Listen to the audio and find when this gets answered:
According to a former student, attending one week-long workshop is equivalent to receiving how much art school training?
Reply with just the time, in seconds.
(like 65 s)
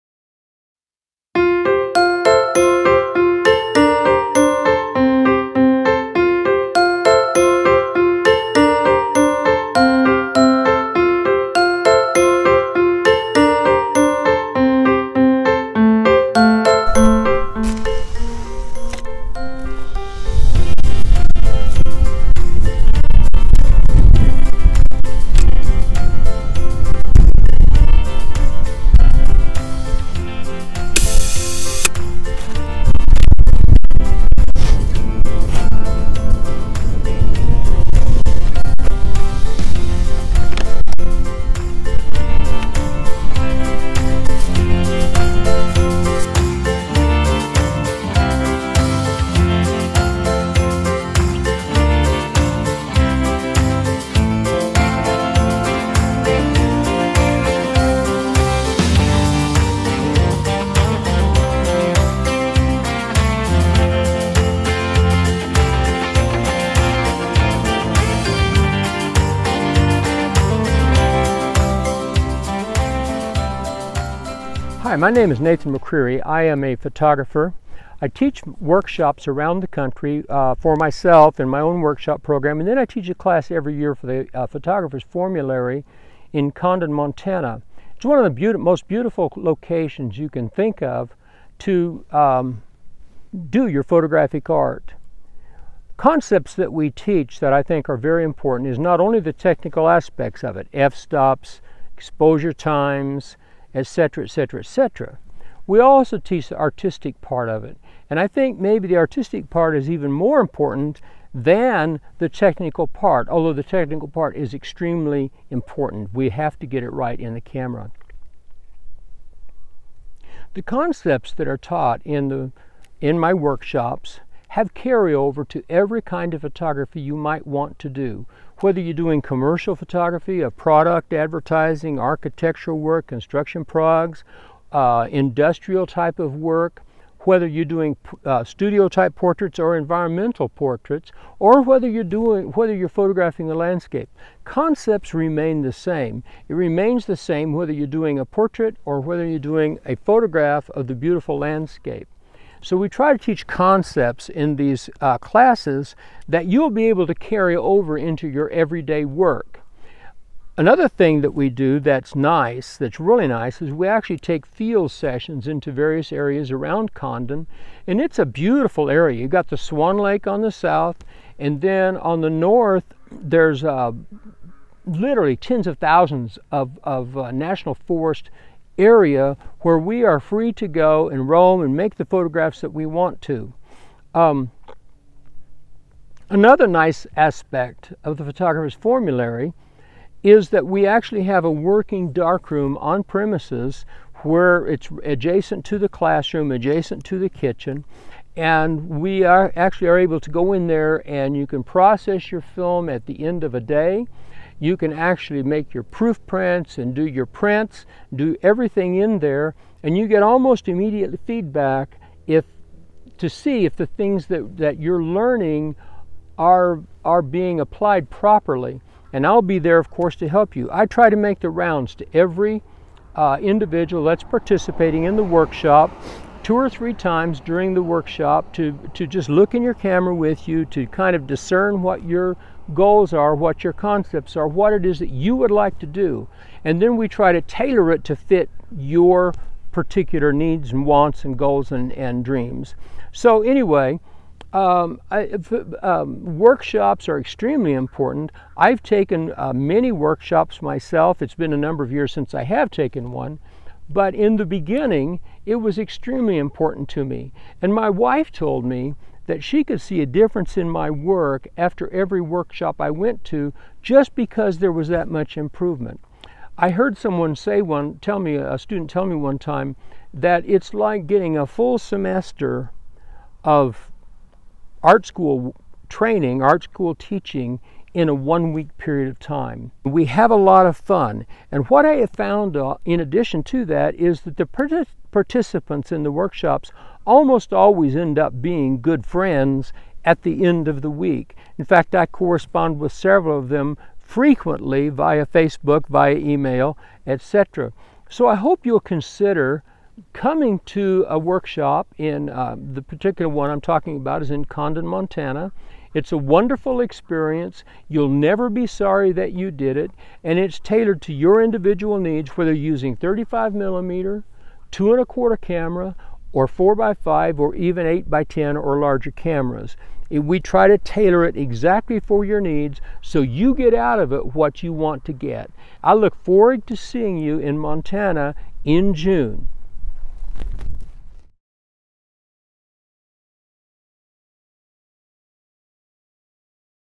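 271 s.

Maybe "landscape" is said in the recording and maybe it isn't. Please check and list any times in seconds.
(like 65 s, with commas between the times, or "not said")
143 s, 151 s.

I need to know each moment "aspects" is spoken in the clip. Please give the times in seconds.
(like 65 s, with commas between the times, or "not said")
99 s, 187 s.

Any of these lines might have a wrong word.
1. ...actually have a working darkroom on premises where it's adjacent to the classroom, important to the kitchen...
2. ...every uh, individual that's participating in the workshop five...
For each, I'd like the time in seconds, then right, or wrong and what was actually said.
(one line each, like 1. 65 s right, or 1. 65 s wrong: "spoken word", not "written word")
1. 190 s wrong: "adjacent", not "important"
2. 222 s wrong: "two", not "five".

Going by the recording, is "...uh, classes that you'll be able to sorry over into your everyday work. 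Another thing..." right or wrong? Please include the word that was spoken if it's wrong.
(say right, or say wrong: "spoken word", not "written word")
wrong: "carry", not "sorry".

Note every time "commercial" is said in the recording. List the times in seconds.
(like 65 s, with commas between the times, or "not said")
129 s.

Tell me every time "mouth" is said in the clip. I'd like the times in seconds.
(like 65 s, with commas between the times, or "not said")
not said.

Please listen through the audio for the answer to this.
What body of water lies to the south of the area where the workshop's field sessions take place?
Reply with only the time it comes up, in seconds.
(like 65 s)
169 s.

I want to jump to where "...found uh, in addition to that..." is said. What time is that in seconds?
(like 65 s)
282 s.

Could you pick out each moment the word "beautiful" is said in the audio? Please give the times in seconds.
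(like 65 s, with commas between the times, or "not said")
88 s, 150 s, 168 s.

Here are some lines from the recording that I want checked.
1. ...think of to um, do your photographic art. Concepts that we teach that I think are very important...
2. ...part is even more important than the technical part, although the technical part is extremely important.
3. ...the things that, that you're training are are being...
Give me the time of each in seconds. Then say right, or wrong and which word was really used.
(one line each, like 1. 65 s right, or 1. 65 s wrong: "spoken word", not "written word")
1. 90 s right
2. 109 s right
3. 213 s wrong: "learning", not "training".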